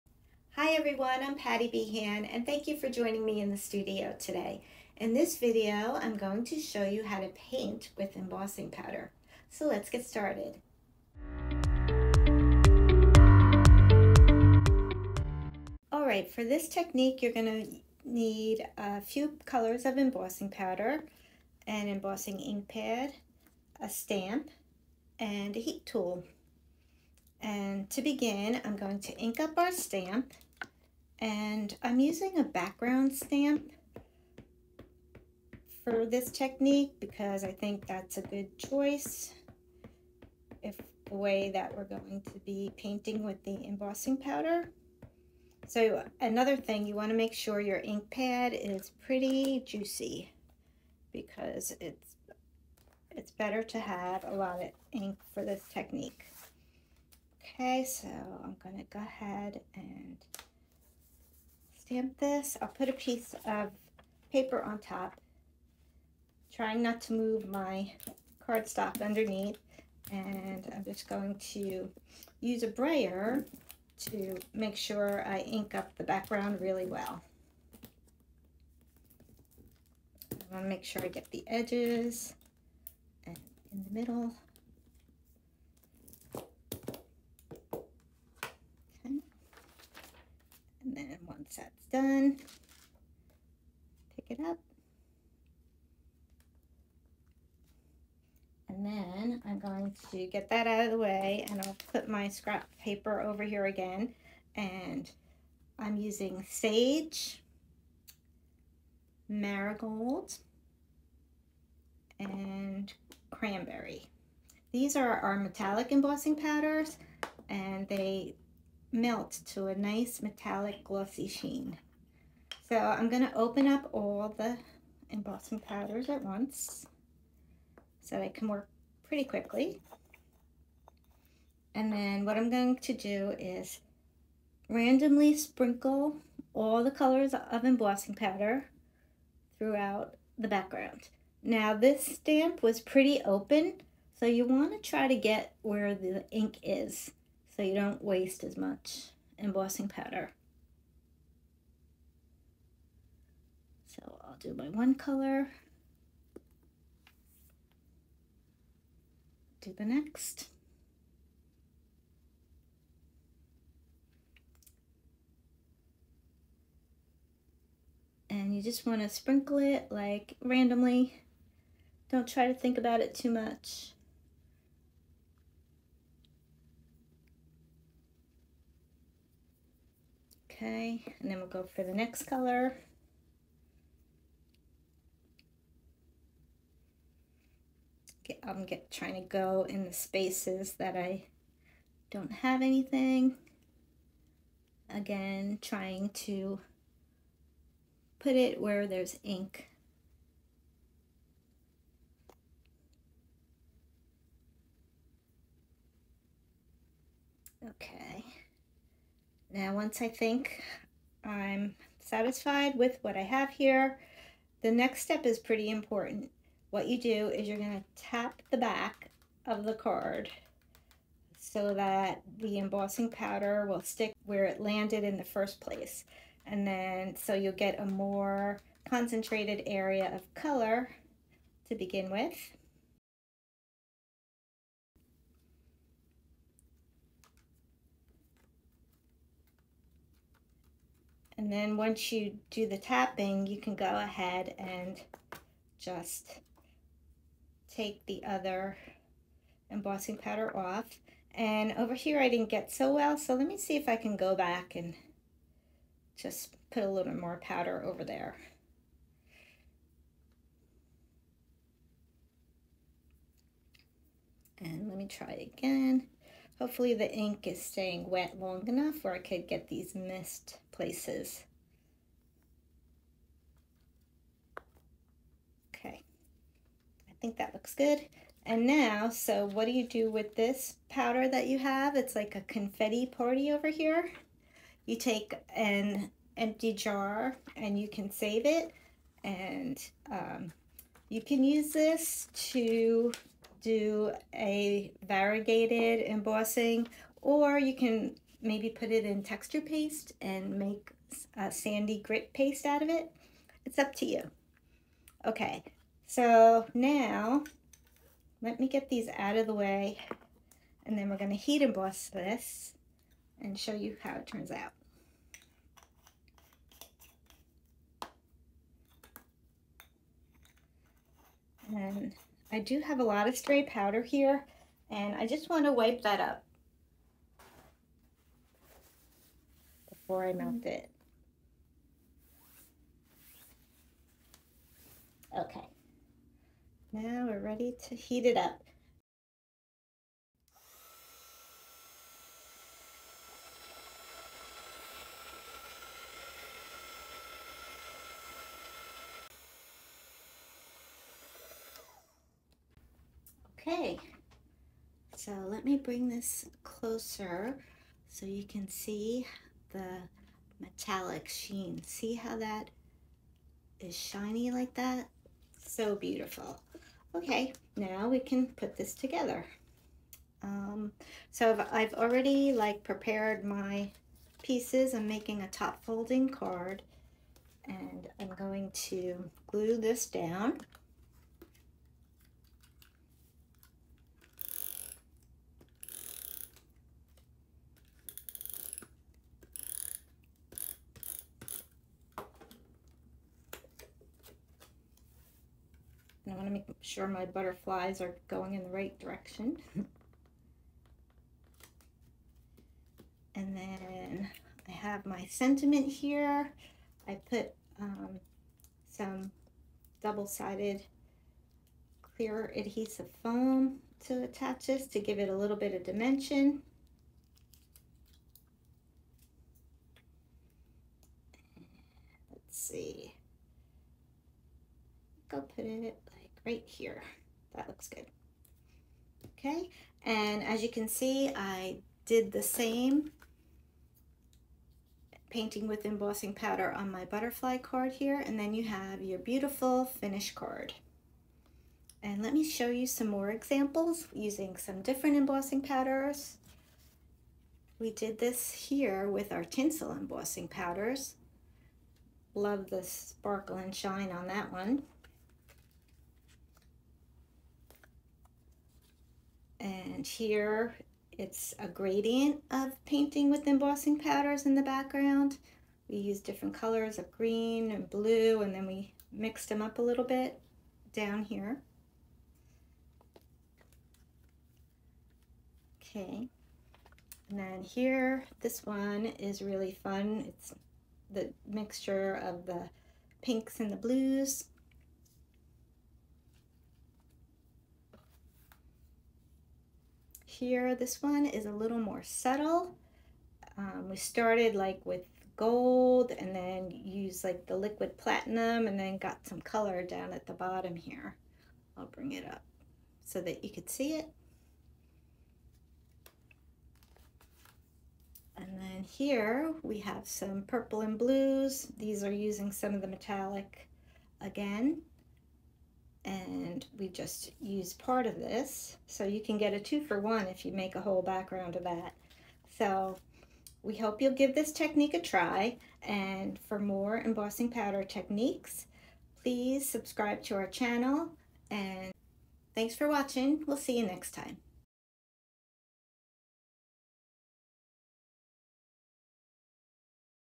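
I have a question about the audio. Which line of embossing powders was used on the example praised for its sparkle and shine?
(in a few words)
Tinsel.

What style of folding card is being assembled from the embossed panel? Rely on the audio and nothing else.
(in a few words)
Top folding card.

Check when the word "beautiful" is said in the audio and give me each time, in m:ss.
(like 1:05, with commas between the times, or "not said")
6:05, 7:19.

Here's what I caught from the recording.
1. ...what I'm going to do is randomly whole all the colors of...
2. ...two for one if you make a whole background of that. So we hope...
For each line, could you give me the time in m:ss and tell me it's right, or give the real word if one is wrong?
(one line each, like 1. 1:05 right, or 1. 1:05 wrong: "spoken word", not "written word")
1. 2:12 wrong: "sprinkle", not "whole"
2. 8:39 right.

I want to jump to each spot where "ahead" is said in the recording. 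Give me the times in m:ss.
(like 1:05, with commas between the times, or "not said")
0:58, 4:03.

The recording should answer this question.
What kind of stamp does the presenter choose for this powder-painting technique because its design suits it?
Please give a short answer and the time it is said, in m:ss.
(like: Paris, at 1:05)
Background stamp, at 0:32.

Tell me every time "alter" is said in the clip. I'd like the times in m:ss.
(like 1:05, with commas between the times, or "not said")
not said.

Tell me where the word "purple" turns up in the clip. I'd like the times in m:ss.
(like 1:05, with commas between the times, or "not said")
8:30.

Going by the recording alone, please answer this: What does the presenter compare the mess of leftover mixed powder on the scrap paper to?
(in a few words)
A confetti party.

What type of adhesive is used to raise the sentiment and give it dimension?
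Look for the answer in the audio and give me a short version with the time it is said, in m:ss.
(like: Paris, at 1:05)
Double-sided clear adhesive foam, at 6:50.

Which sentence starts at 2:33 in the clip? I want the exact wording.
So I'll do my one color, do the next.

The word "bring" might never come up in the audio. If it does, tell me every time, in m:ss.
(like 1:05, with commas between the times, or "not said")
5:55, 8:21.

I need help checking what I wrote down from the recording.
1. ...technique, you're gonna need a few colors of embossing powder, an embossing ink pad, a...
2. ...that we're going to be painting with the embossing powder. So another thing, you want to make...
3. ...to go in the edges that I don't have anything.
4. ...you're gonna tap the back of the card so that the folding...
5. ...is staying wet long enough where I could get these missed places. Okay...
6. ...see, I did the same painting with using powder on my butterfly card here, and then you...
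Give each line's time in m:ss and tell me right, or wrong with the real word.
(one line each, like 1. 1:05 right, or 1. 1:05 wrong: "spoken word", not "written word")
1. 0:16 right
2. 0:41 right
3. 3:09 wrong: "spaces", not "edges"
4. 3:37 wrong: "embossing", not "folding"
5. 4:27 right
6. 7:10 wrong: "embossing", not "using".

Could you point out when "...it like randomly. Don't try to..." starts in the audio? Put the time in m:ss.
2:49.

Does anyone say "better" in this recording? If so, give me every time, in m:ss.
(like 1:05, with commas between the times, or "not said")
0:53.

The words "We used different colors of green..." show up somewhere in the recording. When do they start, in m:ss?
7:45.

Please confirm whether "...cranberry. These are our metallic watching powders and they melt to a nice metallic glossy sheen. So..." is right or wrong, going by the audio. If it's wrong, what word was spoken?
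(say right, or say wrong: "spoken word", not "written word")
wrong: "embossing", not "watching".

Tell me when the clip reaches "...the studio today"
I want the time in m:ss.
0:03.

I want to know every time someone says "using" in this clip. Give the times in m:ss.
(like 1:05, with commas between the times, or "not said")
0:31, 1:45, 7:24, 8:32.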